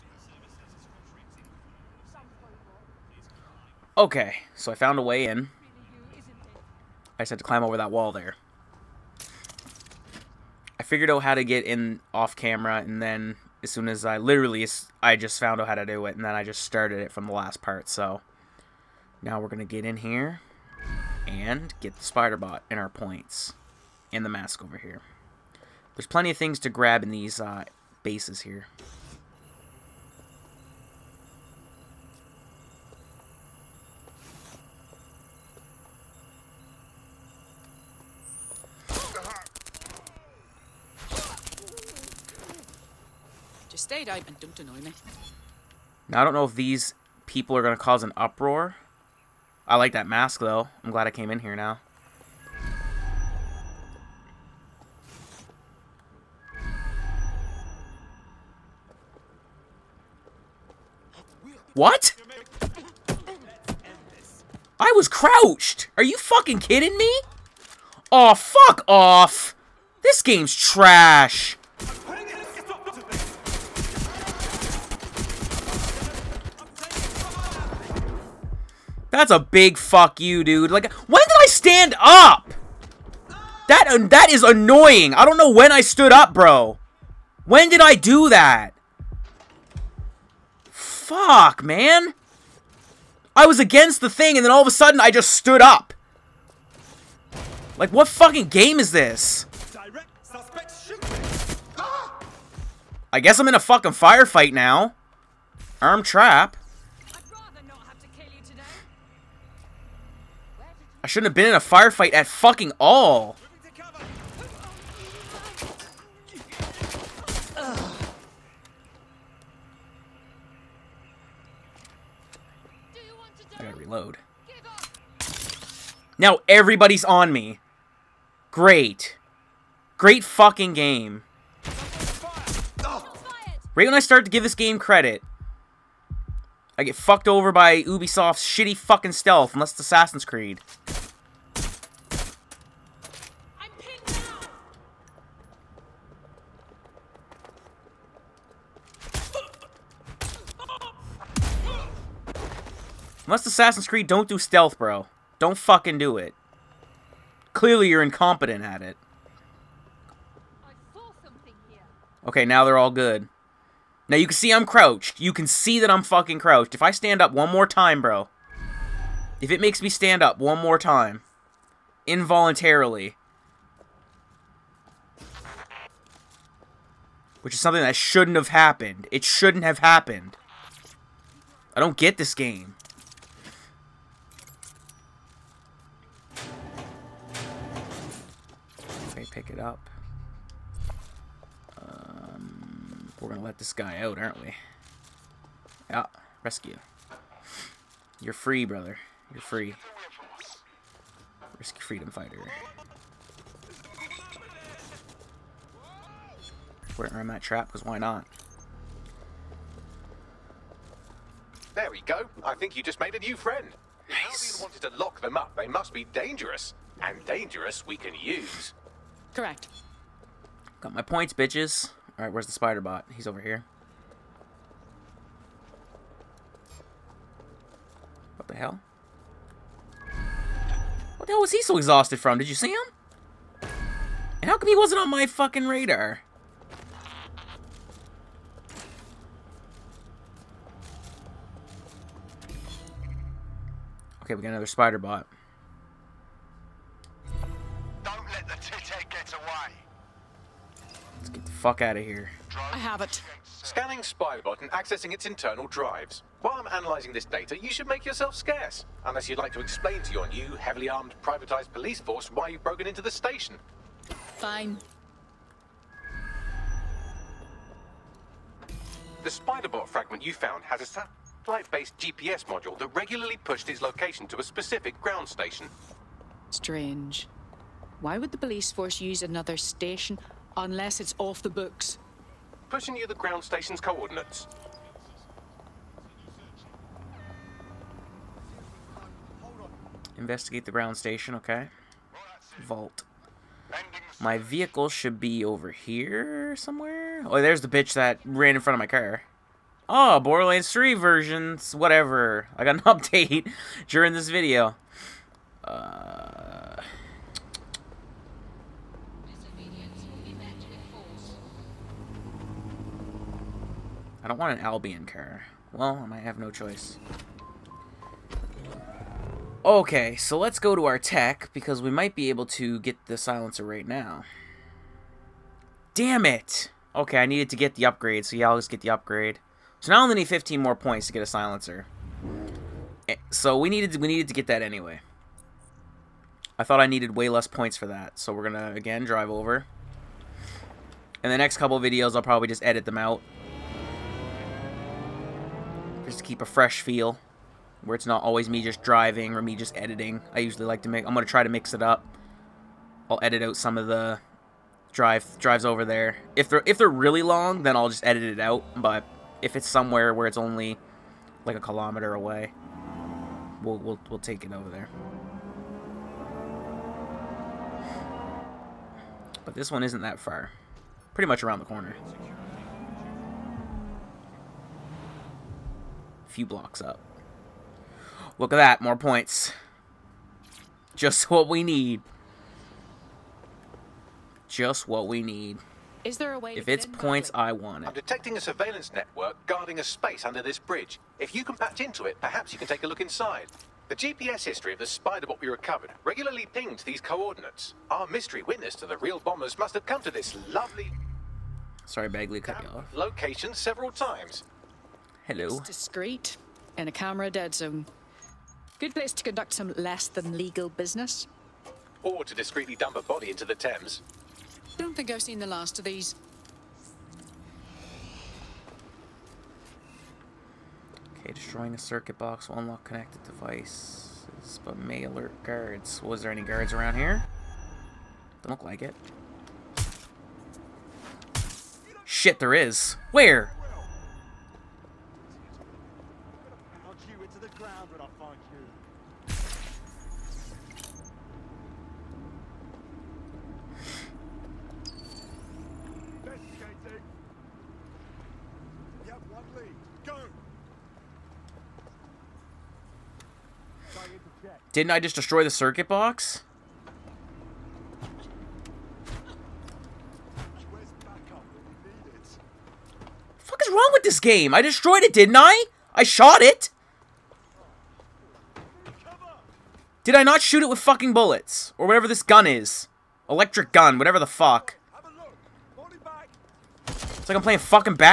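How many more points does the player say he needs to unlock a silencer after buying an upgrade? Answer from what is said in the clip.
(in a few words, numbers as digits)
15.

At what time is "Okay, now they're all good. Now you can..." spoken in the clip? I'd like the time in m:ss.
2:42.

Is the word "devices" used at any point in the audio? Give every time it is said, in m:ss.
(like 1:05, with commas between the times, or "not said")
7:03.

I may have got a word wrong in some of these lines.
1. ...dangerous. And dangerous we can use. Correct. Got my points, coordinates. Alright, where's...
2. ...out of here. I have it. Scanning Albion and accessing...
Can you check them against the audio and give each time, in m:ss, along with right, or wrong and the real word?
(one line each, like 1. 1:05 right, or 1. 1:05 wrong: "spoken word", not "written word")
1. 3:36 wrong: "bitches", not "coordinates"
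2. 4:11 wrong: "Spybot", not "Albion".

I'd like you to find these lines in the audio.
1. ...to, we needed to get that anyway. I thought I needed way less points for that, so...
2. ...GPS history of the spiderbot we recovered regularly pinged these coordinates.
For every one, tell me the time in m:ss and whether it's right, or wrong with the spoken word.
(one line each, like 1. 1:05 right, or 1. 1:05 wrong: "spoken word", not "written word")
1. 5:33 right
2. 6:33 right.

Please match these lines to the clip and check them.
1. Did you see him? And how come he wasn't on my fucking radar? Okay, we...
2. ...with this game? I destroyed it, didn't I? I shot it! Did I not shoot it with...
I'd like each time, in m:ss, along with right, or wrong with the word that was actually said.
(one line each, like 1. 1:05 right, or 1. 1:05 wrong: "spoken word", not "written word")
1. 3:52 right
2. 7:43 right.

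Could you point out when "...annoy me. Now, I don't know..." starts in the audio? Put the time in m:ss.
0:44.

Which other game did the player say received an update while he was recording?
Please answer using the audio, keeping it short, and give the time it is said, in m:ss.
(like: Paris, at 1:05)
Borderlands 3, at 5:00.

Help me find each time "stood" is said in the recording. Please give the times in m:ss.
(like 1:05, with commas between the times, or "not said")
1:25, 1:35.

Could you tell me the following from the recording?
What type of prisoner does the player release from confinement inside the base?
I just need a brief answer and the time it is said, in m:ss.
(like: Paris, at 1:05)
freedom fighter, at 3:21.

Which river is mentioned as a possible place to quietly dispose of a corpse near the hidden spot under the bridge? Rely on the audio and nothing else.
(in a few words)
Thames.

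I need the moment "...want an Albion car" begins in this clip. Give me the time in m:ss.
5:14.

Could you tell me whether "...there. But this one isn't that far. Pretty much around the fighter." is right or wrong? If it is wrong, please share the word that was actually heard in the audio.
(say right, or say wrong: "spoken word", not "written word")
wrong: "corner", not "fighter".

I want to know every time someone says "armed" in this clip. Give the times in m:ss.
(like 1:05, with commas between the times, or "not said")
4:20.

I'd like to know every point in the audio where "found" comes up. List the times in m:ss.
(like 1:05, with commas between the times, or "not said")
0:04, 0:15, 4:30.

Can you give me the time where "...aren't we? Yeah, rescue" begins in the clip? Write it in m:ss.
3:14.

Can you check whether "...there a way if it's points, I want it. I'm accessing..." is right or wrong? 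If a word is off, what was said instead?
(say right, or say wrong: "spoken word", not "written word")
wrong: "detecting", not "accessing".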